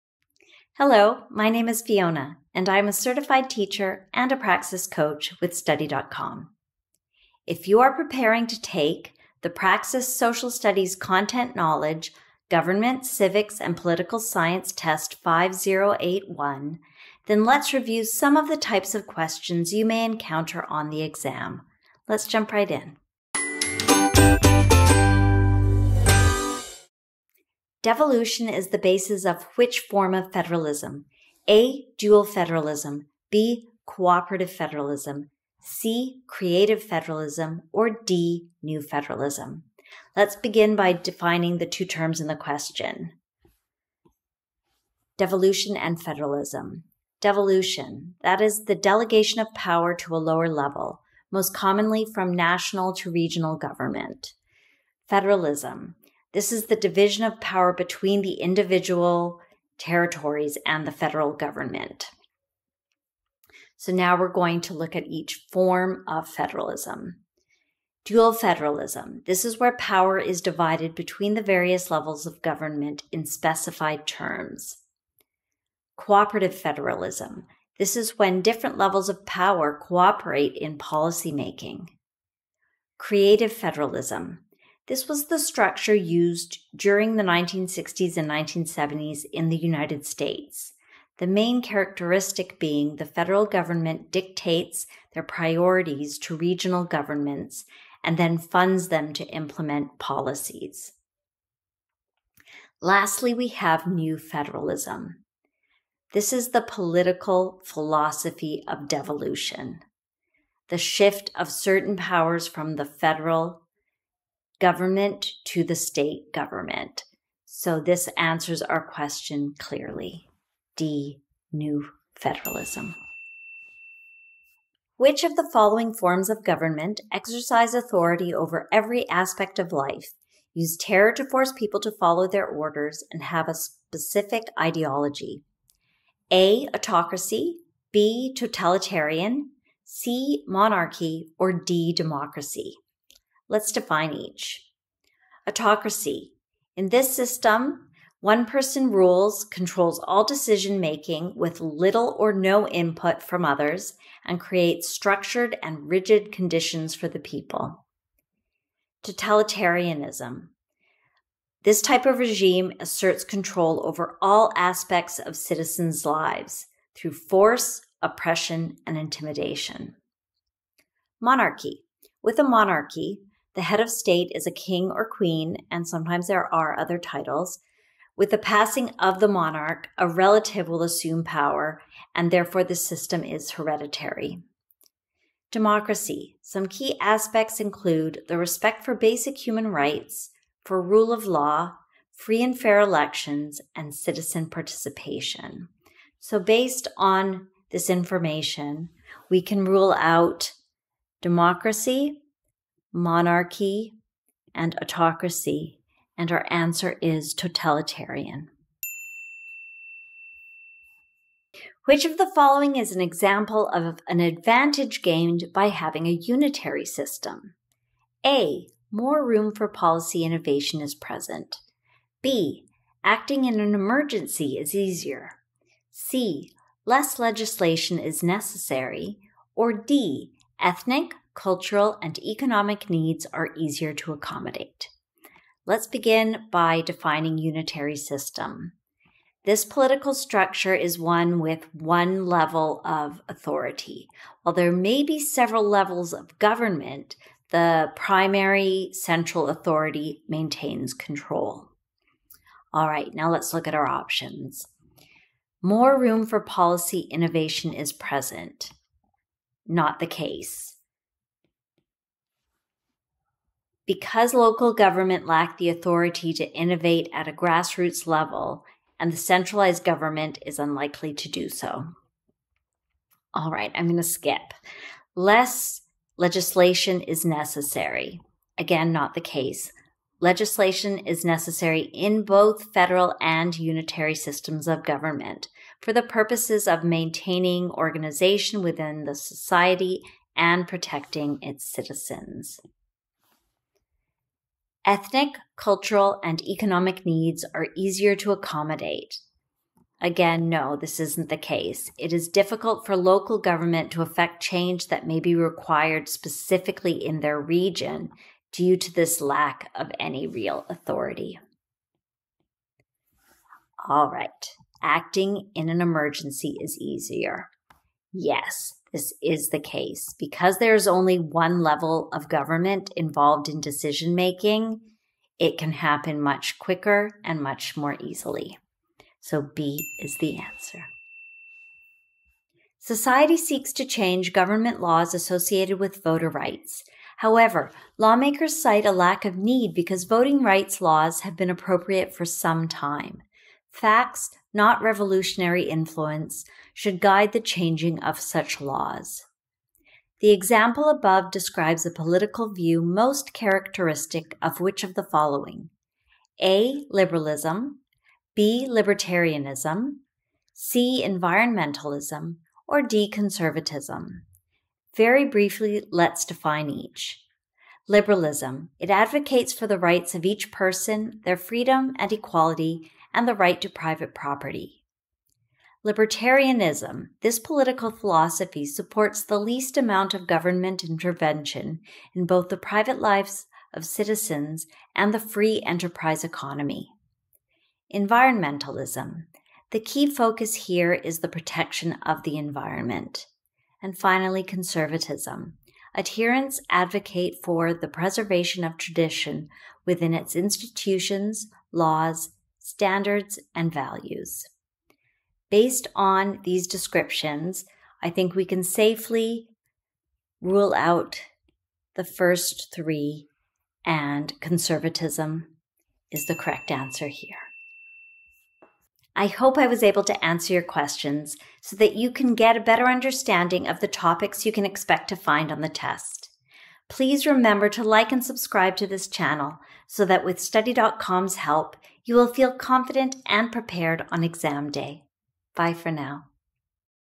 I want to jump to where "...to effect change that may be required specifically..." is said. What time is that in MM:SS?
05:03.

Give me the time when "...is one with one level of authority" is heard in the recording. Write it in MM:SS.
04:00.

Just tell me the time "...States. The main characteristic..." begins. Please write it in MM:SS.
01:30.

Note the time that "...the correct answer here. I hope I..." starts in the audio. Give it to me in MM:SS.
06:56.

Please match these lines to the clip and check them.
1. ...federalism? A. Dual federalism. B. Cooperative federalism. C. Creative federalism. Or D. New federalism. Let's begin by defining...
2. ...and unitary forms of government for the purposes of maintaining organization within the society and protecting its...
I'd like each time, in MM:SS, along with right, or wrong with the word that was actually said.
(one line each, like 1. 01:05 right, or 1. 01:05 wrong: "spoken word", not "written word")
1. 00:30 right
2. 04:43 wrong: "systems", not "forms".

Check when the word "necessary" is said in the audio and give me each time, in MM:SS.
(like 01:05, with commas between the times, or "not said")
03:48, 04:37, 04:41.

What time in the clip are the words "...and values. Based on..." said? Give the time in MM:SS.
06:43.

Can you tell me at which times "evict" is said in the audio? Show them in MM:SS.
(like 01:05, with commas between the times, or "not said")
not said.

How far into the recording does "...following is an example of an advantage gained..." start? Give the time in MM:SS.
03:32.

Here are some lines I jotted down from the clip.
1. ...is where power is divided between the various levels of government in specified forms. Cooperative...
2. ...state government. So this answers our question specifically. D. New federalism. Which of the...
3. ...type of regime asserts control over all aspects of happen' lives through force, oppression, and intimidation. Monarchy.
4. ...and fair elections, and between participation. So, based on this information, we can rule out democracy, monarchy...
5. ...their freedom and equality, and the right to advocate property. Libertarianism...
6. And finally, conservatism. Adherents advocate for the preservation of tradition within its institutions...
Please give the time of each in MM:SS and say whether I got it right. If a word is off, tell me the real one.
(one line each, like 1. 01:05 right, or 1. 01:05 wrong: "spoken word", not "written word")
1. 01:09 wrong: "terms", not "forms"
2. 01:55 wrong: "clearly", not "specifically"
3. 02:41 wrong: "citizens", not "happen"
4. 03:12 wrong: "citizen", not "between"
5. 06:11 wrong: "private", not "advocate"
6. 06:33 right.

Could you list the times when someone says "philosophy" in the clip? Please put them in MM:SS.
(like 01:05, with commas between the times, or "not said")
01:47, 06:17.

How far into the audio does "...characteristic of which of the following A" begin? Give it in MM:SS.
05:53.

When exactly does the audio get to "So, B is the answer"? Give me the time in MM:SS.
05:29.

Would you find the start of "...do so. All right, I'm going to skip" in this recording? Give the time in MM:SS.
04:31.